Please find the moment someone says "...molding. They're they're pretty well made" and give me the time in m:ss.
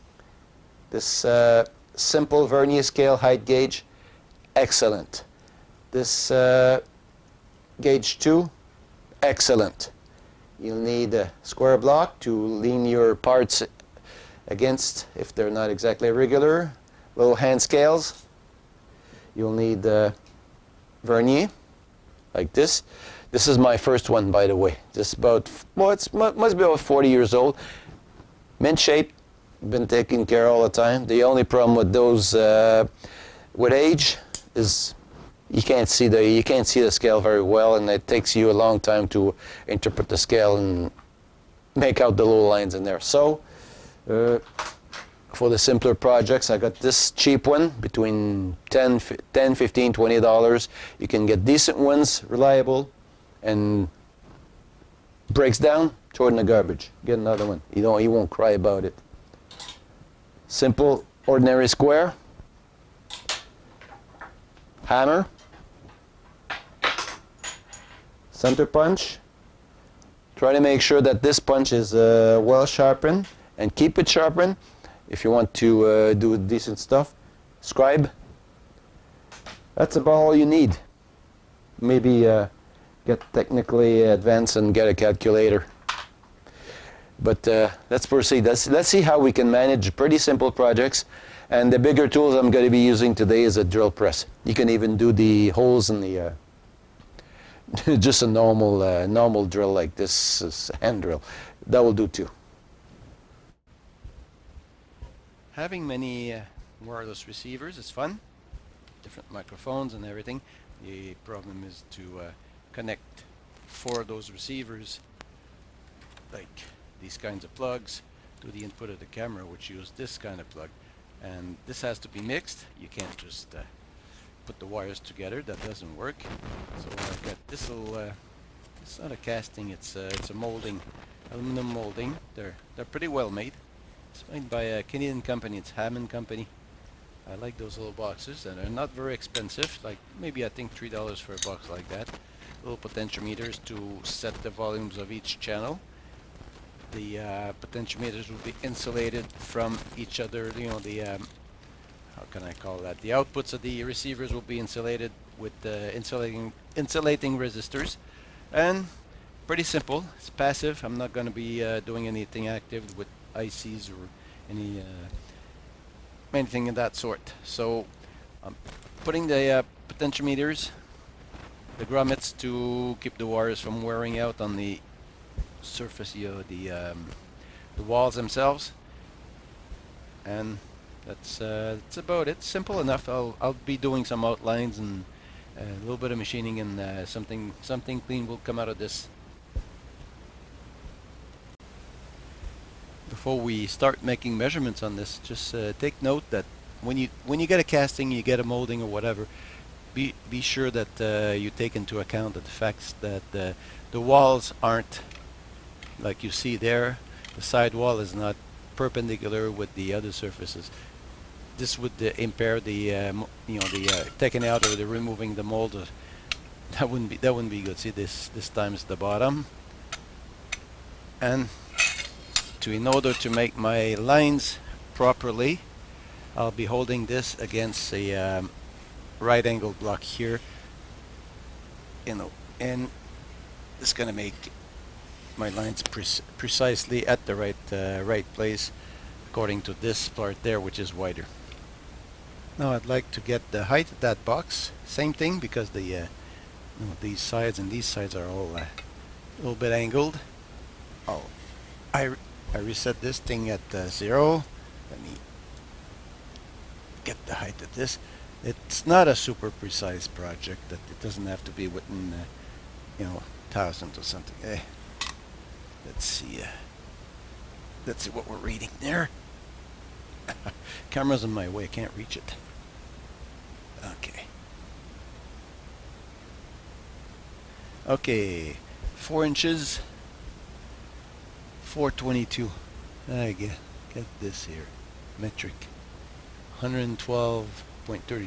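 2:11.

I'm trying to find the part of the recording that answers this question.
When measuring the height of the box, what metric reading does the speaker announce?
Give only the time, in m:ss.
4:46.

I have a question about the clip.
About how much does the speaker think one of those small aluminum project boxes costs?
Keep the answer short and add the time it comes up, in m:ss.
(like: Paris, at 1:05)
3 dollars, at 2:20.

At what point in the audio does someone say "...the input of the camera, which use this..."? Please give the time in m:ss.
1:58.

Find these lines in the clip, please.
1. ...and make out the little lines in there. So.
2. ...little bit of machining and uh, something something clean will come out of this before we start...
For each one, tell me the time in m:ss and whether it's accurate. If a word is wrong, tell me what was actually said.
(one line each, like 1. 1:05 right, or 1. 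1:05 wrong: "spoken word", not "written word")
1. 0:40 right
2. 3:05 right.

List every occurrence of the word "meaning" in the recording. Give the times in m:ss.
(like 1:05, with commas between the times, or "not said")
not said.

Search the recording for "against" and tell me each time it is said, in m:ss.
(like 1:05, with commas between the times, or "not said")
0:14, 3:47.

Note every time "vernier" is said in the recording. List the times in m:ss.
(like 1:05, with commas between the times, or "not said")
0:02, 0:21.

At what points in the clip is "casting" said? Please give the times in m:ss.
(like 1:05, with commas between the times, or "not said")
2:09, 3:17.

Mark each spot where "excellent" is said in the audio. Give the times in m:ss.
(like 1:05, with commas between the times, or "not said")
0:04, 0:09.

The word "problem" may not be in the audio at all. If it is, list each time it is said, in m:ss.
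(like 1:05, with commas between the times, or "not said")
0:31, 1:51.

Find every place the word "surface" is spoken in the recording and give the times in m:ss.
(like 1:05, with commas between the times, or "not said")
2:55, 3:30.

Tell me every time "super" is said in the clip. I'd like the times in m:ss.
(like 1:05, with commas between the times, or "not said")
4:19.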